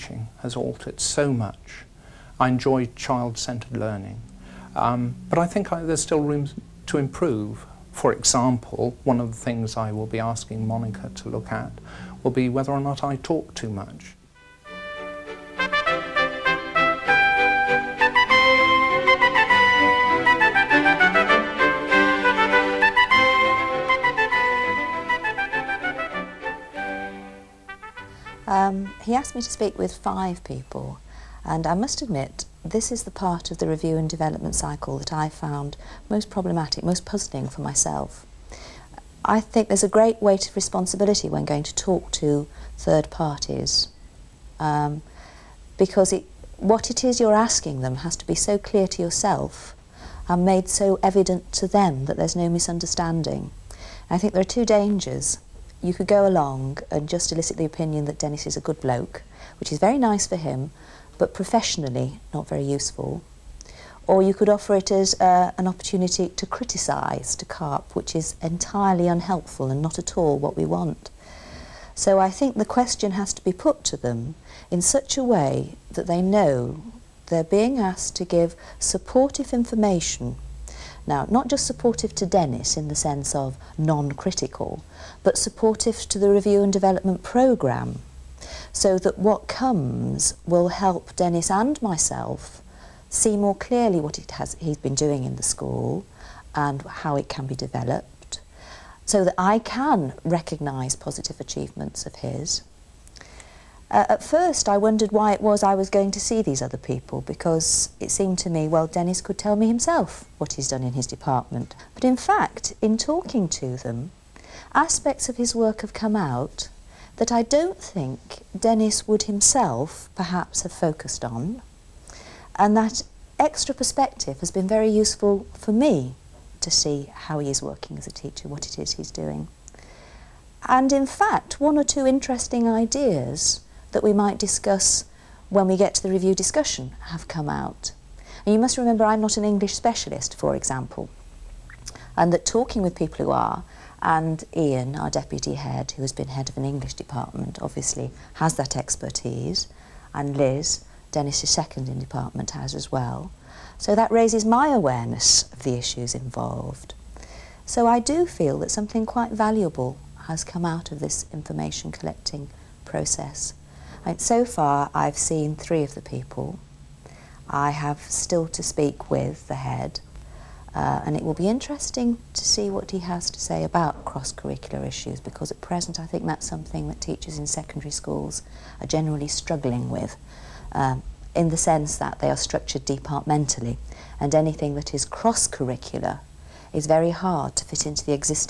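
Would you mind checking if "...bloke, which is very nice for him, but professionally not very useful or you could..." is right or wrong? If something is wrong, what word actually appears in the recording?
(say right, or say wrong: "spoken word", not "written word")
right.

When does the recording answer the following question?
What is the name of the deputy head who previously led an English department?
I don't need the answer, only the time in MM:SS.
02:24.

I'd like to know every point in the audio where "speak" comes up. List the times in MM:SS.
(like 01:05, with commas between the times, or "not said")
00:29, 02:48.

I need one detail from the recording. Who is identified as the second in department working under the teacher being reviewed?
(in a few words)
Liz.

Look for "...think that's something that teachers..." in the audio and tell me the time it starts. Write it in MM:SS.
02:56.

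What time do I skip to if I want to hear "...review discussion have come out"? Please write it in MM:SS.
02:16.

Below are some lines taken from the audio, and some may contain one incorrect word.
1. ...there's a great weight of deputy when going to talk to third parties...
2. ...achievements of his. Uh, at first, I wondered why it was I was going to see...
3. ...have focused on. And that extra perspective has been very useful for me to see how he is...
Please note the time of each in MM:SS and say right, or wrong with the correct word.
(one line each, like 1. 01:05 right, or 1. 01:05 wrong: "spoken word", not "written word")
1. 00:39 wrong: "responsibility", not "deputy"
2. 01:41 right
3. 02:00 right.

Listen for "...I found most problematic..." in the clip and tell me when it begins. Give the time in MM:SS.
00:35.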